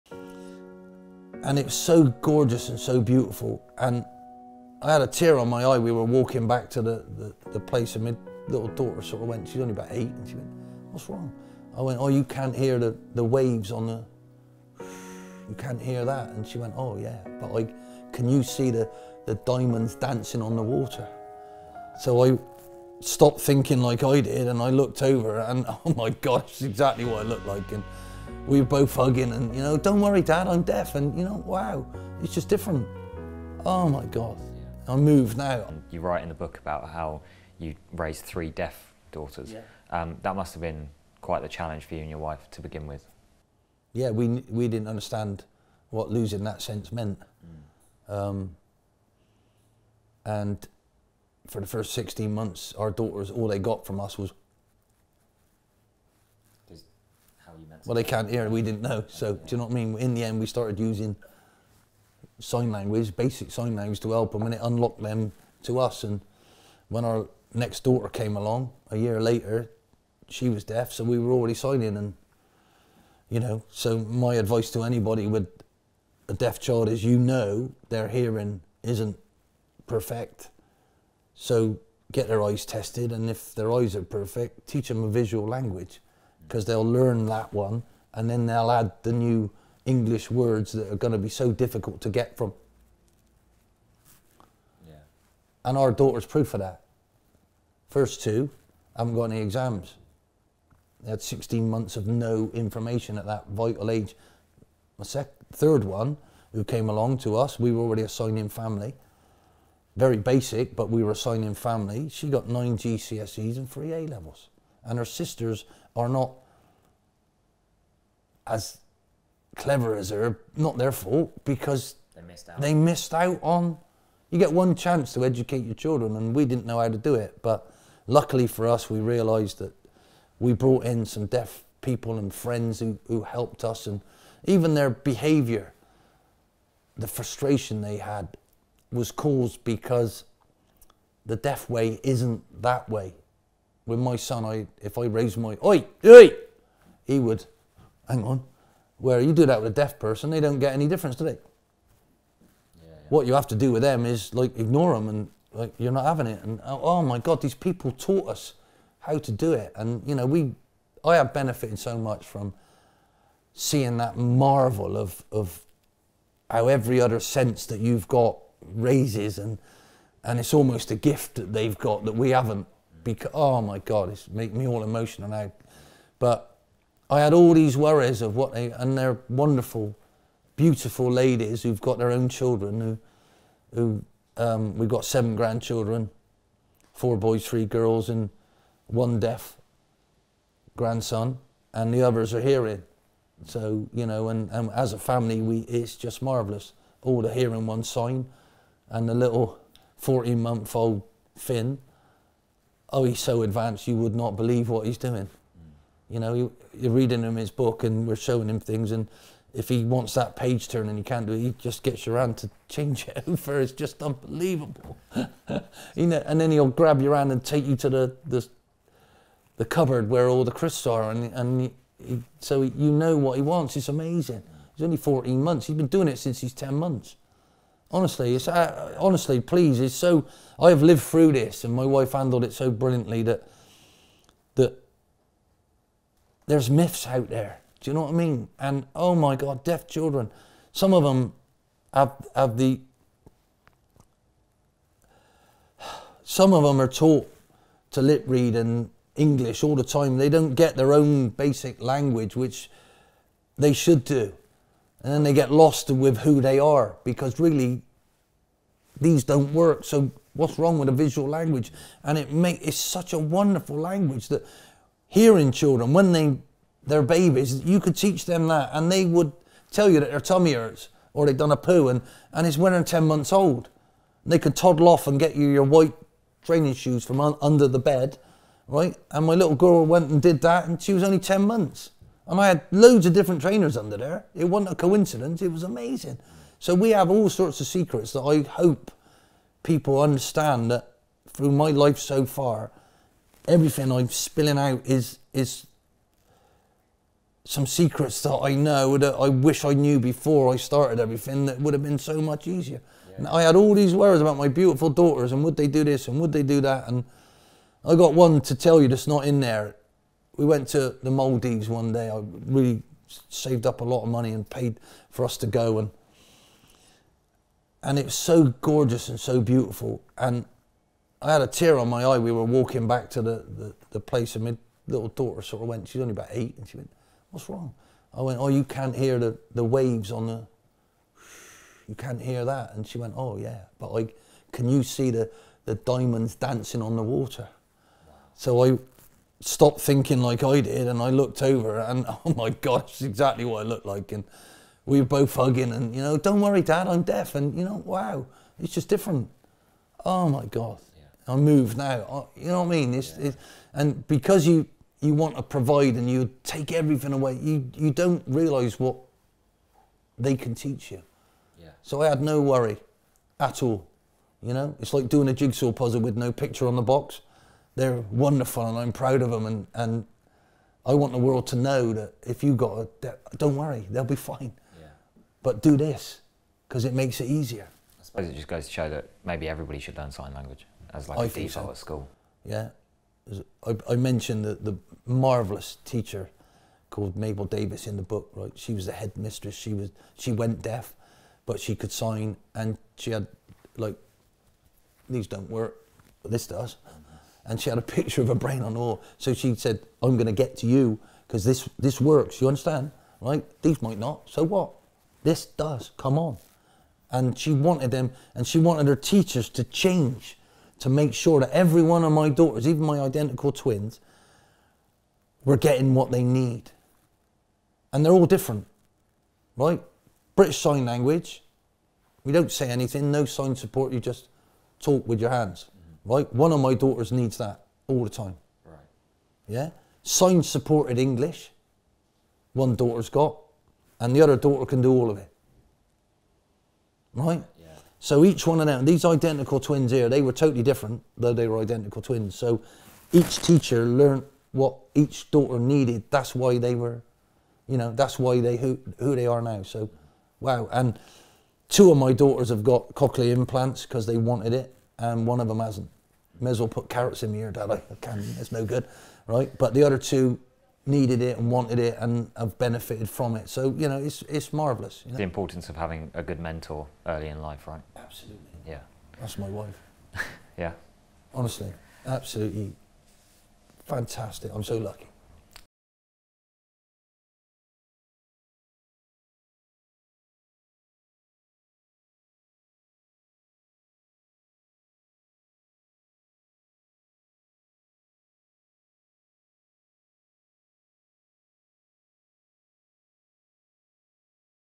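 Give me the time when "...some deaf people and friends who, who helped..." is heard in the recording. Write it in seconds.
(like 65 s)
131 s.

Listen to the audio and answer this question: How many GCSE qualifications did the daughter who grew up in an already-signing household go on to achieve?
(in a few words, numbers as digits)
9.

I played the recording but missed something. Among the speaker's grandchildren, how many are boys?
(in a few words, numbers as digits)
4.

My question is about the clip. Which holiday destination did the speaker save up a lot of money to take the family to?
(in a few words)
Maldives.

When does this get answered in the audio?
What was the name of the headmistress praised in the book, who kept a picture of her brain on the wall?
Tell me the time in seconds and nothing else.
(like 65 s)
387 s.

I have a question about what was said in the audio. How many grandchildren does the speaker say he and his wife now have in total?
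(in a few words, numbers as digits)
7.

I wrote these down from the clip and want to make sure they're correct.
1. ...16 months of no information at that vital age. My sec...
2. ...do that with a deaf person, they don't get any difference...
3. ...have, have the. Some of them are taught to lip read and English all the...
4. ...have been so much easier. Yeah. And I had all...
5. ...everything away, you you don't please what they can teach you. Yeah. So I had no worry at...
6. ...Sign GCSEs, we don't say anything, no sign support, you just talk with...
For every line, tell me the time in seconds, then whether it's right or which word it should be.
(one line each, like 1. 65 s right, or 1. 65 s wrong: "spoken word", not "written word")
1. 101 s right
2. 149 s right
3. 241 s right
4. 301 s right
5. 356 s wrong: "realise", not "please"
6. 420 s wrong: "Language", not "GCSEs".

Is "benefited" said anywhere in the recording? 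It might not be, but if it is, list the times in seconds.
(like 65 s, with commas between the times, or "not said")
161 s, 462 s.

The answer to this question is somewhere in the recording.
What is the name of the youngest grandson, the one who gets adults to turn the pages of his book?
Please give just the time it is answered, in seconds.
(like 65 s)
201 s.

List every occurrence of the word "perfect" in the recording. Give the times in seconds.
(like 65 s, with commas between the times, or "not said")
79 s, 84 s.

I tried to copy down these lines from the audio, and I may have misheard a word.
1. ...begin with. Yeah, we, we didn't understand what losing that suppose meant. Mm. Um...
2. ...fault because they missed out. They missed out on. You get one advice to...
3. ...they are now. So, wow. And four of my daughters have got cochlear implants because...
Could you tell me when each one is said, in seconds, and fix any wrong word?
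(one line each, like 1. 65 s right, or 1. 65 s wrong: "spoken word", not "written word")
1. 42 s wrong: "sense", not "suppose"
2. 120 s wrong: "chance", not "advice"
3. 449 s wrong: "two", not "four".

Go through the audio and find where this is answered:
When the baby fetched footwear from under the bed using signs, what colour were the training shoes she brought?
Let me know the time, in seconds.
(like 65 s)
275 s.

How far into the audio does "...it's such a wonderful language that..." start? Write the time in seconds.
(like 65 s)
262 s.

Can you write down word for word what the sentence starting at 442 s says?
So each teacher learned what each daughter needed.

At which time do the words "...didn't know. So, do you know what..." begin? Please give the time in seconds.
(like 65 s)
58 s.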